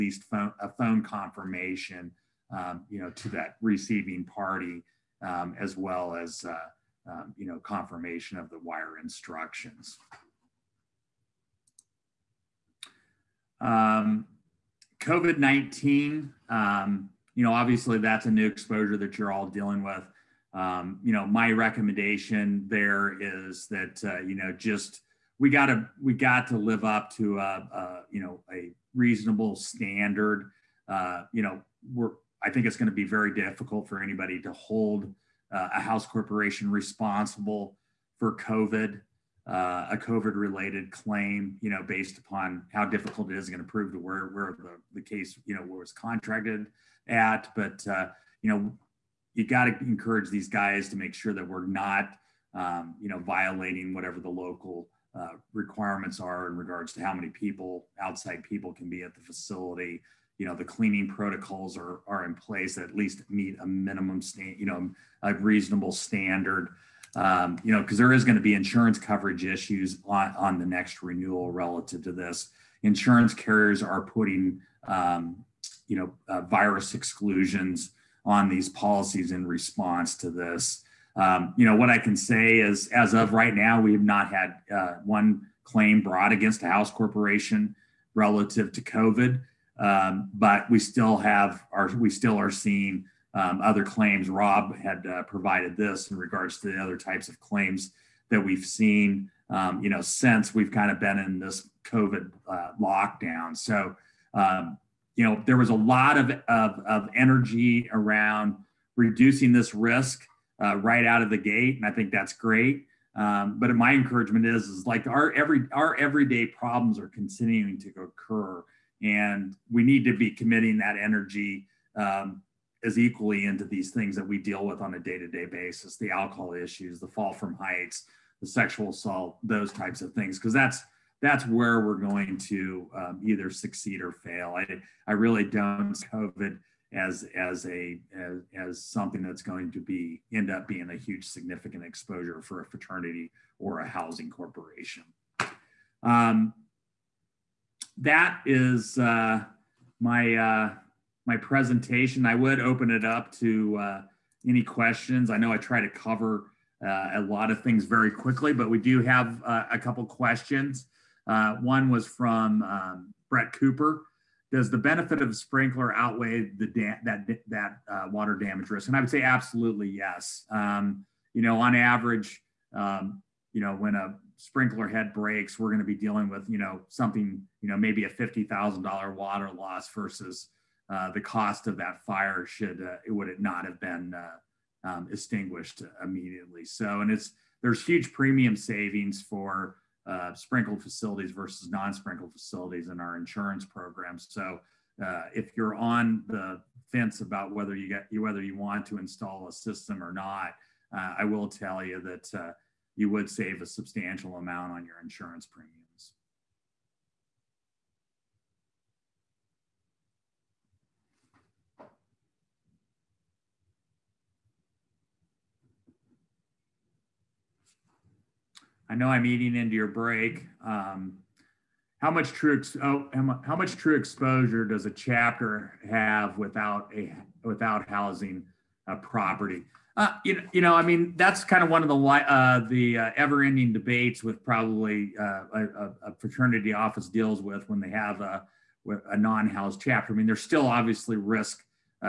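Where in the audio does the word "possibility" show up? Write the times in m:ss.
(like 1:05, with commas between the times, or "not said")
not said.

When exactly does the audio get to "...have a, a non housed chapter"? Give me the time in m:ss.
3:57.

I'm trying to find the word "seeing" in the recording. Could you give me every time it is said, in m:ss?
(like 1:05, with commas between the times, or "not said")
1:32.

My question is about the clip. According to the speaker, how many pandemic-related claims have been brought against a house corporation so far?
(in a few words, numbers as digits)
1 claim? No—none (not one).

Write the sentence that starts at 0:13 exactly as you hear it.
Um, COVID-19, um, you know, obviously that's a new exposure that you're all dealing with.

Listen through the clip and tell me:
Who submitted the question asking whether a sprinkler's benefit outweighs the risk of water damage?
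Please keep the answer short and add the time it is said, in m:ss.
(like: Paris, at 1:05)
Brett Cooper, at 2:43.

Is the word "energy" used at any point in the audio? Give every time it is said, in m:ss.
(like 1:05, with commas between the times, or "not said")
1:47, 2:00.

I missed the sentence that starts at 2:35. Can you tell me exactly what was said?
I know I try to cover uh, a lot of things very quickly, but we do have uh, a couple questions.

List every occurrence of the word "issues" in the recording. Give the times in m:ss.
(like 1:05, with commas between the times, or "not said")
1:09, 2:06.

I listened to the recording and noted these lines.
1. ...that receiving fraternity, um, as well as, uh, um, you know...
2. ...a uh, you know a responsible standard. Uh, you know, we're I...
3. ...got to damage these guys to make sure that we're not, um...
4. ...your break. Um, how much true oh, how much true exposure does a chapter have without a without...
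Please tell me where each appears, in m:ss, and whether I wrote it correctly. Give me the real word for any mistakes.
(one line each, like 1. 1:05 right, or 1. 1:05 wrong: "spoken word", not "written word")
1. 0:03 wrong: "party", not "fraternity"
2. 0:27 wrong: "reasonable", not "responsible"
3. 0:49 wrong: "encourage", not "damage"
4. 3:39 right.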